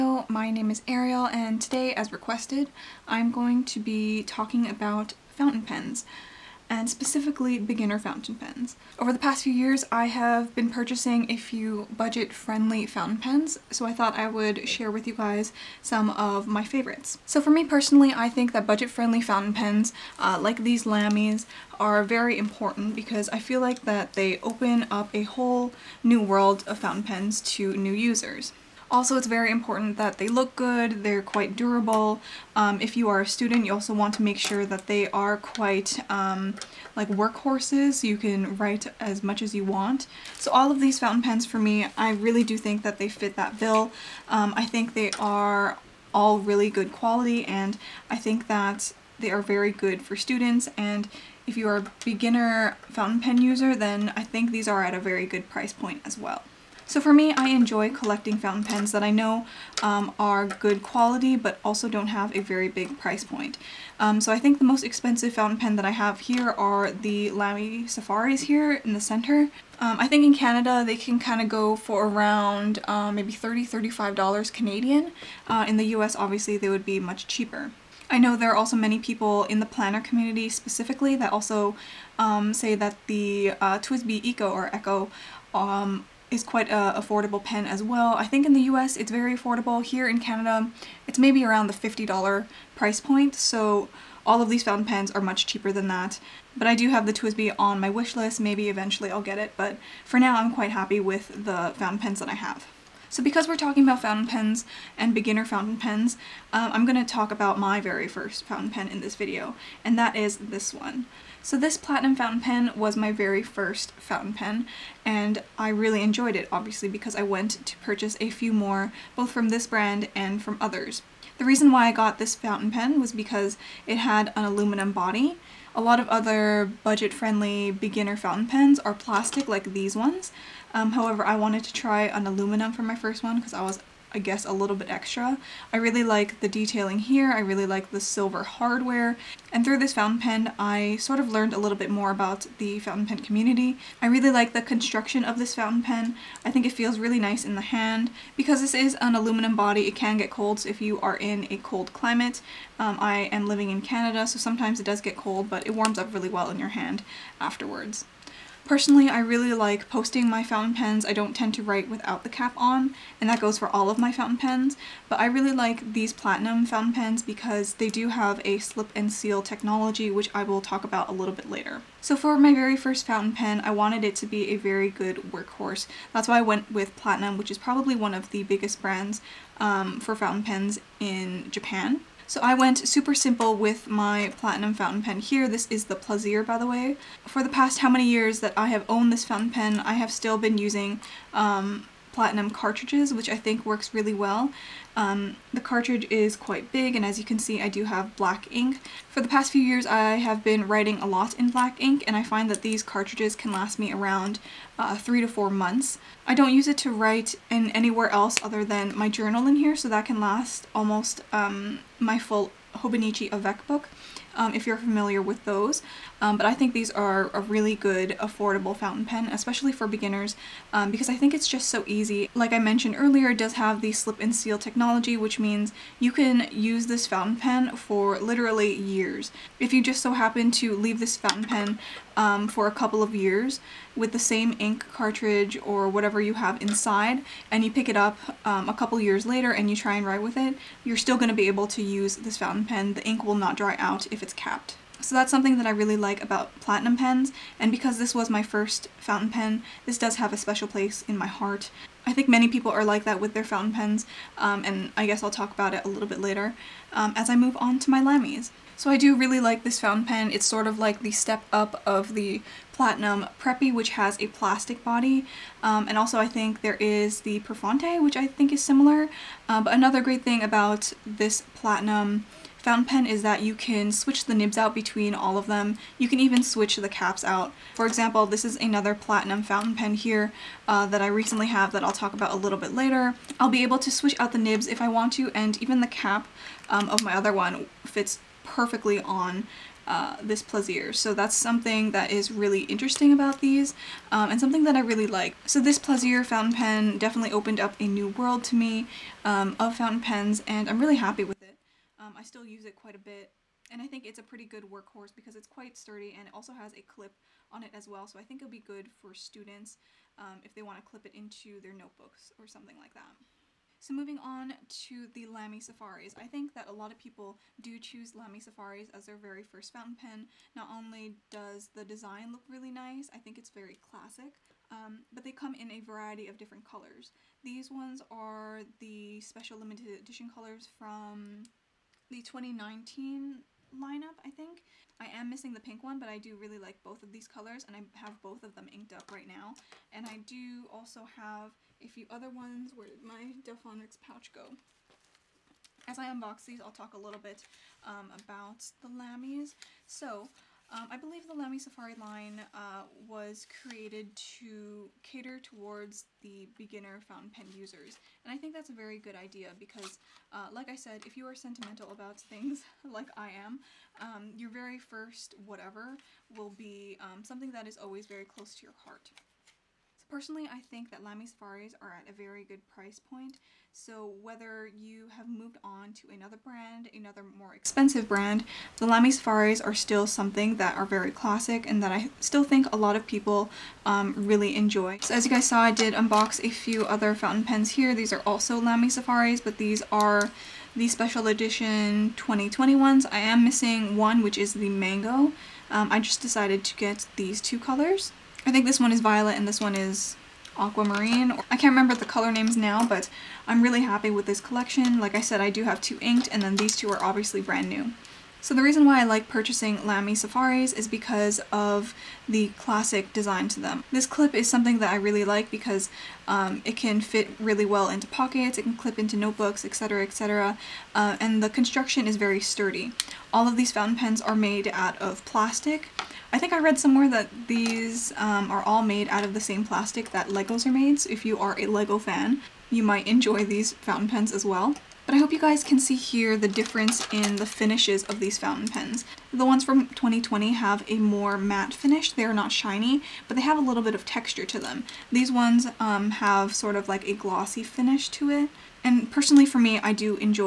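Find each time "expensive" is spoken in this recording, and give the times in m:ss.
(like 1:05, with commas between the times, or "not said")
1:04, 6:17.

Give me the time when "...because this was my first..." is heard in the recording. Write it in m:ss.
4:07.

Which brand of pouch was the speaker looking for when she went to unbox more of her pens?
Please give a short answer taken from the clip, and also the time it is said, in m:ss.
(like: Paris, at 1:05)
Delphonics, at 5:43.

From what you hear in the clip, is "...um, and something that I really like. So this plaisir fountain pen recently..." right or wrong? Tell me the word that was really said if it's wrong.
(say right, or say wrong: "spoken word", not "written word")
wrong: "definitely", not "recently".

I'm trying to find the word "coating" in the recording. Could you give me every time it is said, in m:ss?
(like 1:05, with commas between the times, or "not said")
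not said.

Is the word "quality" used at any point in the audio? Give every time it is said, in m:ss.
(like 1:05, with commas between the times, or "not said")
0:46, 1:00.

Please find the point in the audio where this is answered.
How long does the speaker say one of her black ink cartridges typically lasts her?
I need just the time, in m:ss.
3:24.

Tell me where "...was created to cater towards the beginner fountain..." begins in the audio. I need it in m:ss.
5:53.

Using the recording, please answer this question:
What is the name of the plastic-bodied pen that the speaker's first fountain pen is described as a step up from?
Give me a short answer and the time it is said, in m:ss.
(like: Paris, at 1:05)
Platinum Preppy, at 4:22.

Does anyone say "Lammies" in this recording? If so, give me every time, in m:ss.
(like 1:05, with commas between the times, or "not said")
0:20, 5:48.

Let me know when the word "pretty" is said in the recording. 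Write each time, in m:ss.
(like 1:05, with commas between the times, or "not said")
5:04.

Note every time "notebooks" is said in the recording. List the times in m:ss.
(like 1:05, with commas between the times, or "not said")
5:11, 6:59.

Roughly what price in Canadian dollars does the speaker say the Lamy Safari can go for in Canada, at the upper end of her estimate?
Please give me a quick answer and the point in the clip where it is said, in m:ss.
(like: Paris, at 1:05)
$35, at 1:13.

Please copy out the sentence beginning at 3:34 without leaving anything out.
Um, if you're familiar with those.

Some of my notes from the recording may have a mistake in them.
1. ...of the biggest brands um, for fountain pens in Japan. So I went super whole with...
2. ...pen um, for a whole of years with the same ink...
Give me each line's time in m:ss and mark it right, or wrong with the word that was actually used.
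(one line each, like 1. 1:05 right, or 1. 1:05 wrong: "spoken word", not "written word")
1. 2:58 wrong: "simple", not "whole"
2. 3:51 wrong: "couple", not "whole".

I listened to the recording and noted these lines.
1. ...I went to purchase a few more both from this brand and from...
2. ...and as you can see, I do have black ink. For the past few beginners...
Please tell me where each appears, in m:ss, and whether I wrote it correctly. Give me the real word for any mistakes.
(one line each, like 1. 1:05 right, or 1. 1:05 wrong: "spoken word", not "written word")
1. 1:57 right
2. 3:16 wrong: "years", not "beginners".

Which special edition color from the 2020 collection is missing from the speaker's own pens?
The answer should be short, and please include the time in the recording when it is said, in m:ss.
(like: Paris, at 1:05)
Mango, at 6:34.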